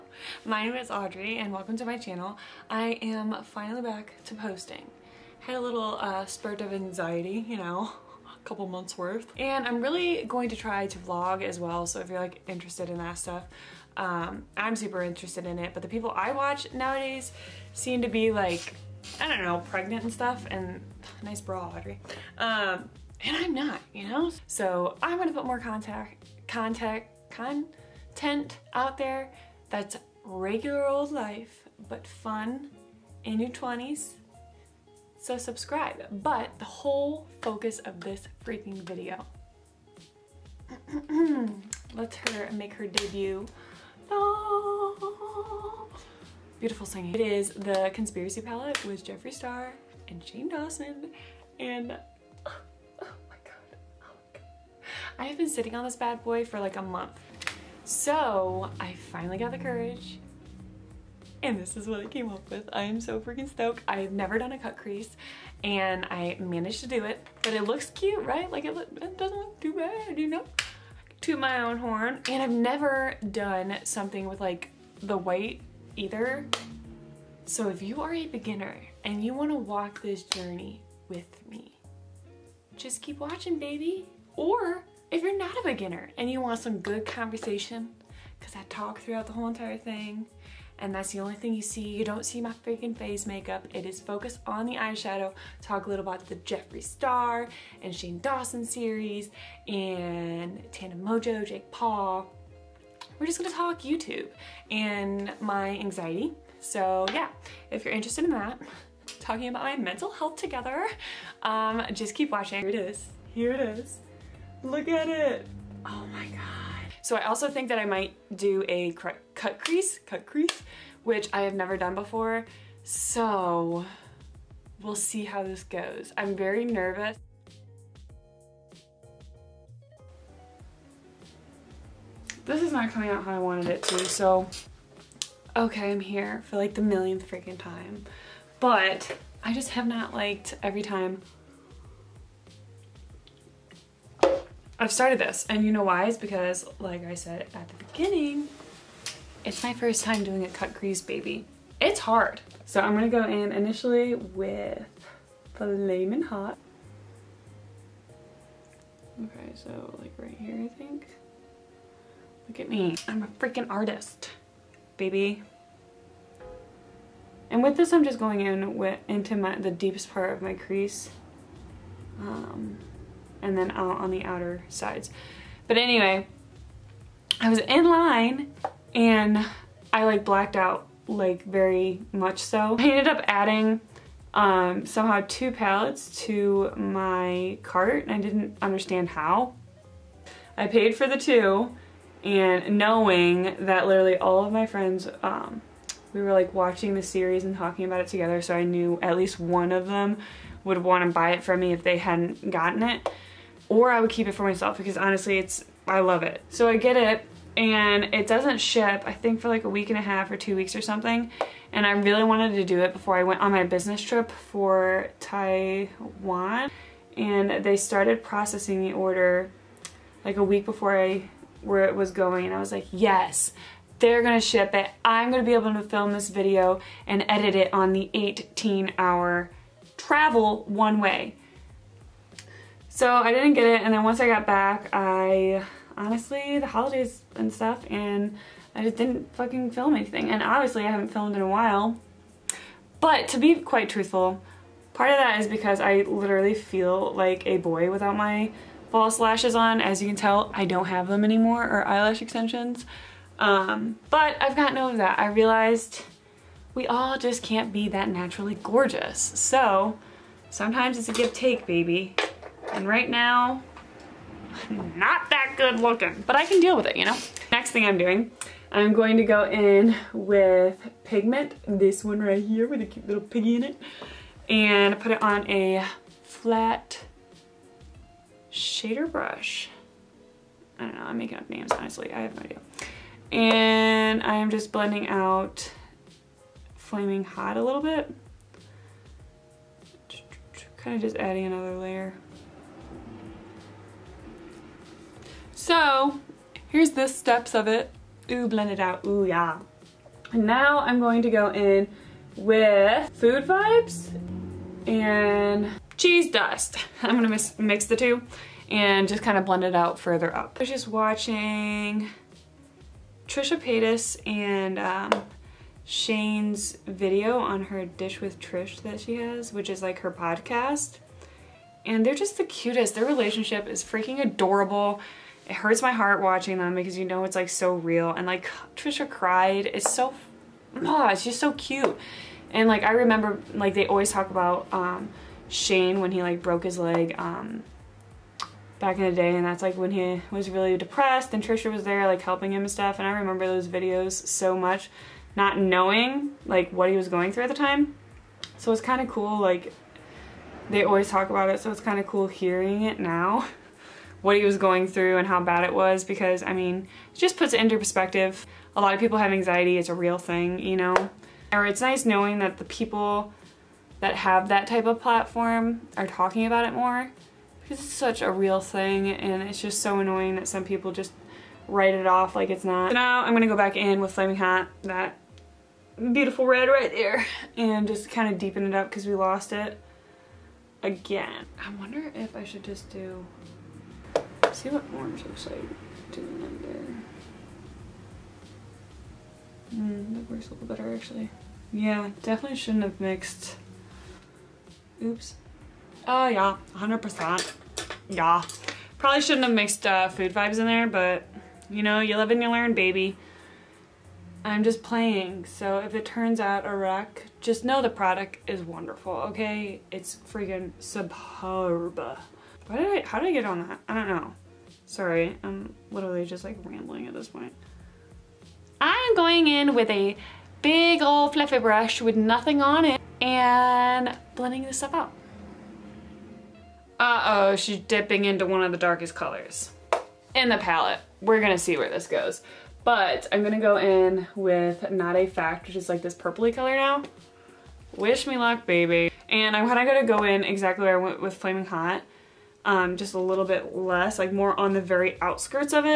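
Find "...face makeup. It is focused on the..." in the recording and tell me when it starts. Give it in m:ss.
1:32.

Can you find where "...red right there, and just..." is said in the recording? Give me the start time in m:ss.
6:16.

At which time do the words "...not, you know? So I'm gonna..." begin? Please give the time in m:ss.
0:23.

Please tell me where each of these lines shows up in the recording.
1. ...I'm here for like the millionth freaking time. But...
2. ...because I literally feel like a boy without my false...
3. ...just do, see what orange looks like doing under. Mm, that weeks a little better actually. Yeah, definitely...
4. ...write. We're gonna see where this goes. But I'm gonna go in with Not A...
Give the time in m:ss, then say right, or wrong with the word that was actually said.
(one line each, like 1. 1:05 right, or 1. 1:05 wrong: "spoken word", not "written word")
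1. 2:15 right
2. 4:05 right
3. 6:22 wrong: "works", not "weeks"
4. 7:10 wrong: "palette", not "write".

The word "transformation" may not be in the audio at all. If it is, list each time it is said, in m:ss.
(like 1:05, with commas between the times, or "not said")
not said.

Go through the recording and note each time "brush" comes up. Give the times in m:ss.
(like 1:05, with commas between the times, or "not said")
4:39, 7:01.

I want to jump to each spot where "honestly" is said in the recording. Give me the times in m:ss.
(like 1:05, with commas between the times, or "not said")
3:24, 3:55, 4:41.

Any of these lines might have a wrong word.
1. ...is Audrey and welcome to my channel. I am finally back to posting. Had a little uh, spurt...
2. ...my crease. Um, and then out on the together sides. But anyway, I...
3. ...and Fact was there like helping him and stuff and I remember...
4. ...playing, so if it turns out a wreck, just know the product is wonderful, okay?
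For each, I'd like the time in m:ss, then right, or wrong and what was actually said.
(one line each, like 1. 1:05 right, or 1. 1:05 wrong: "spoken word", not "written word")
1. 0:00 right
2. 2:50 wrong: "outer", not "together"
3. 5:41 wrong: "Trisha", not "Fact"
4. 6:44 right.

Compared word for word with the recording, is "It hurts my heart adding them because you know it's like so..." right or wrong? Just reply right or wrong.
wrong.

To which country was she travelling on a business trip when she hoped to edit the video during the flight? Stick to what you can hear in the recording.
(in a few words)
Taiwan.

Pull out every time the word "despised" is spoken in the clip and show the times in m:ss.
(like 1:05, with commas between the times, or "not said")
not said.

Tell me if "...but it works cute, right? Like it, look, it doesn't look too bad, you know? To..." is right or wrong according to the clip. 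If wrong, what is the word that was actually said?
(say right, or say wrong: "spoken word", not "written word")
wrong: "looks", not "works".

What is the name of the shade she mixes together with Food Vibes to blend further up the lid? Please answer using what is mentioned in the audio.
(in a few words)
Cheese Dust.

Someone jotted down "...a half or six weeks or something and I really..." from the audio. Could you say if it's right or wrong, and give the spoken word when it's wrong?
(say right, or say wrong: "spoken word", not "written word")
wrong: "two", not "six".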